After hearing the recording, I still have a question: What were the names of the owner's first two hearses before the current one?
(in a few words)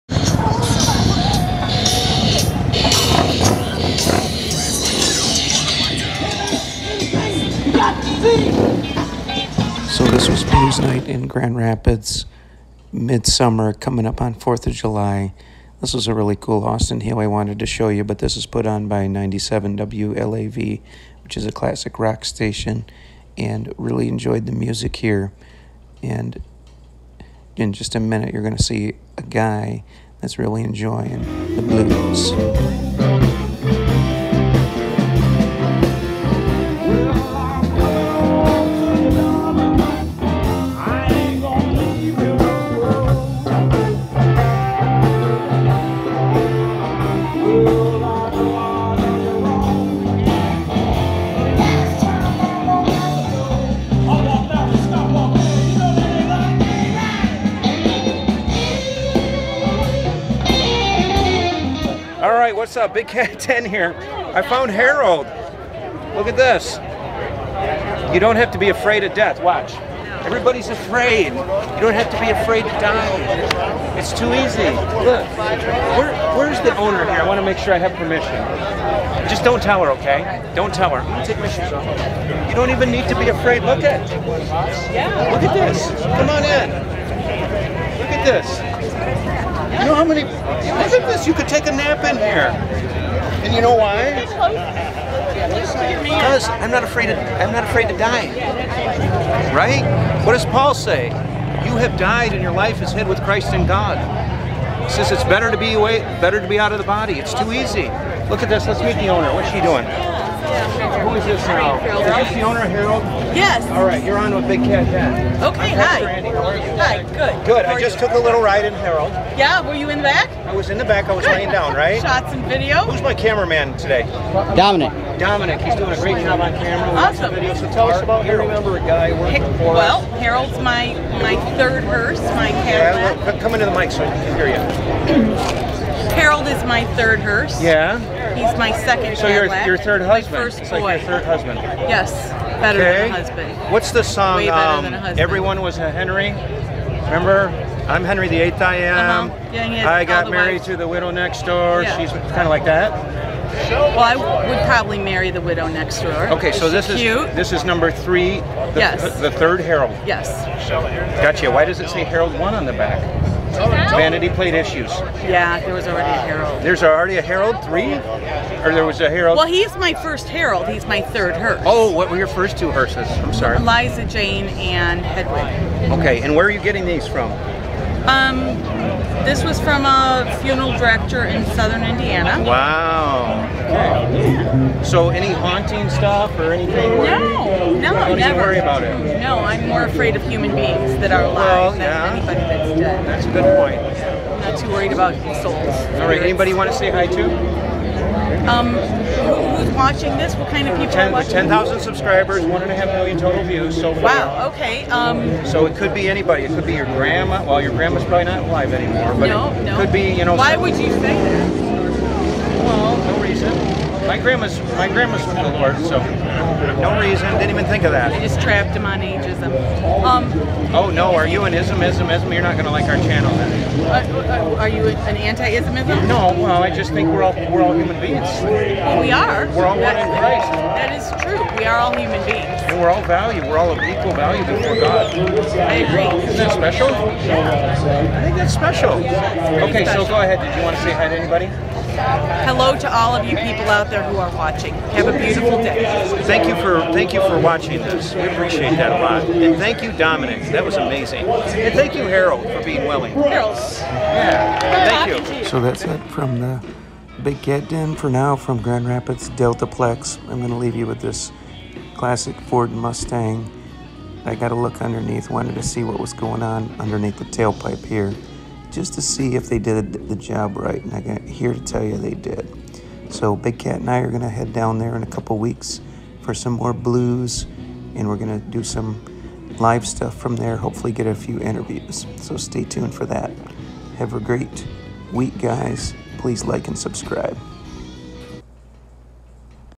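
Eliza Jane and Hedwig.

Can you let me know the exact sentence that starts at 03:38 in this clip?
I just trapped him on ageism.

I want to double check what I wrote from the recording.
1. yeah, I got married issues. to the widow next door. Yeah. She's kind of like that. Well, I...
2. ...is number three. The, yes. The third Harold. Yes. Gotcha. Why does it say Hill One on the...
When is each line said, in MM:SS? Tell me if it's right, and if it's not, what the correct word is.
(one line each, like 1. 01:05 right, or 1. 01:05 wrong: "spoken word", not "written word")
1. 02:29 wrong: "wives", not "issues"
2. 02:37 wrong: "Harold", not "Hill".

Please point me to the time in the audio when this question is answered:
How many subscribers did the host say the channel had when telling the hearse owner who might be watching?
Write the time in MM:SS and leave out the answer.
03:21.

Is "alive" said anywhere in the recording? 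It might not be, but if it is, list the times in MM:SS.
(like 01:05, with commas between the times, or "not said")
03:11, 03:28.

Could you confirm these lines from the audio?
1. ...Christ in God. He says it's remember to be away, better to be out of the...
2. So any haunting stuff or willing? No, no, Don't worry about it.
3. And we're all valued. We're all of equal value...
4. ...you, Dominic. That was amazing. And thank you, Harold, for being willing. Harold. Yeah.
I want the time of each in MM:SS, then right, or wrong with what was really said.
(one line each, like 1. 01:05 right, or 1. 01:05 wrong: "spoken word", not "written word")
1. 01:43 wrong: "better", not "remember"
2. 03:04 wrong: "anything", not "willing"
3. 03:52 right
4. 04:09 right.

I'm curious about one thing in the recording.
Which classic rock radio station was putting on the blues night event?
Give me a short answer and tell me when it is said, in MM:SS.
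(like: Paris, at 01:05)
97 WLAV, at 00:19.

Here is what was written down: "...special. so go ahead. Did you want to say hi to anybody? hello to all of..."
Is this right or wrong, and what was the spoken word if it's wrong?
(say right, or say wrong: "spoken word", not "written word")
right.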